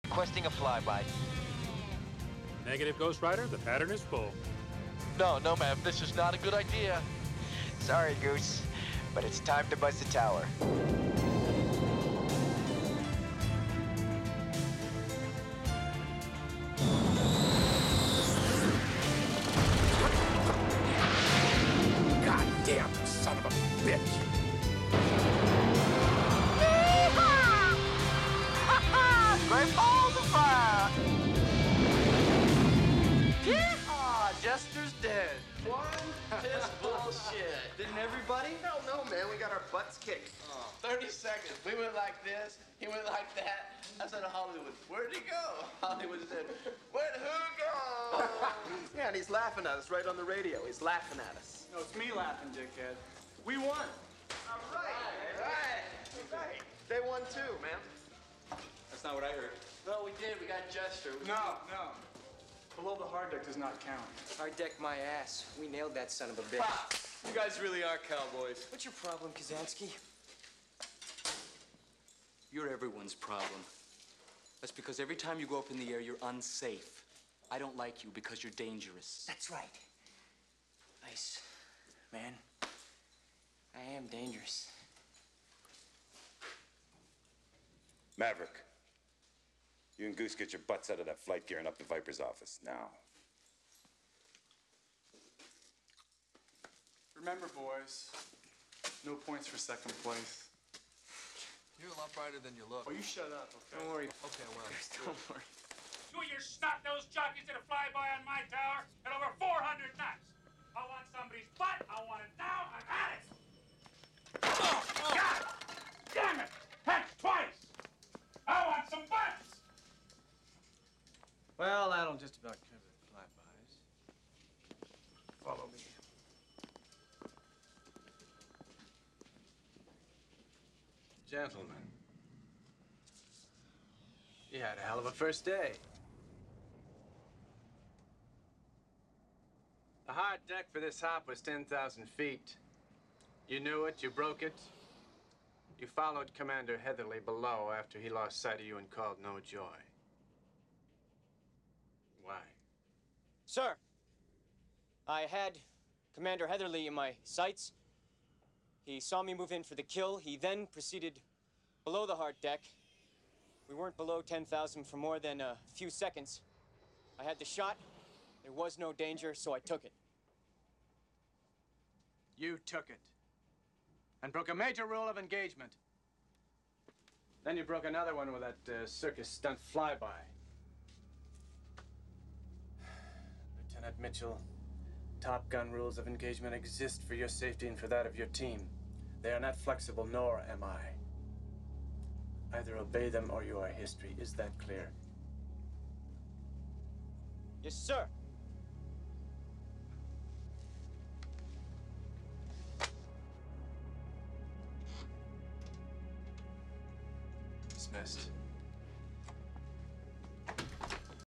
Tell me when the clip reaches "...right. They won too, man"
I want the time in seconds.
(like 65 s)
56 s.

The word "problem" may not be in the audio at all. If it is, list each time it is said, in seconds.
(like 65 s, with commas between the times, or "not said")
69 s, 73 s.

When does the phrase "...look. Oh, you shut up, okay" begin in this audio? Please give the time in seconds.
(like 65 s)
102 s.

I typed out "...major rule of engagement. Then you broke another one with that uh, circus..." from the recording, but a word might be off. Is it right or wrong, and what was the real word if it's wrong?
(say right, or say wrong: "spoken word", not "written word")
right.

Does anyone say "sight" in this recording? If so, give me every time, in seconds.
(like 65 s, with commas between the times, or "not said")
148 s, 157 s.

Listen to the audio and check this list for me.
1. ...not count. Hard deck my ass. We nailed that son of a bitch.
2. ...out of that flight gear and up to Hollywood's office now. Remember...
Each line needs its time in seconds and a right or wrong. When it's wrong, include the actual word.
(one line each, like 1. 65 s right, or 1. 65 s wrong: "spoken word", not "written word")
1. 63 s right
2. 90 s wrong: "Viper", not "Hollywood".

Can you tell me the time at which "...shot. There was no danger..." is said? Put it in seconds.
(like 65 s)
167 s.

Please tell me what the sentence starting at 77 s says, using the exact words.
I don't like you because you're dangerous.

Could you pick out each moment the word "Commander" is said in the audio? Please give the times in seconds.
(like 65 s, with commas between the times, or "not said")
146 s, 156 s.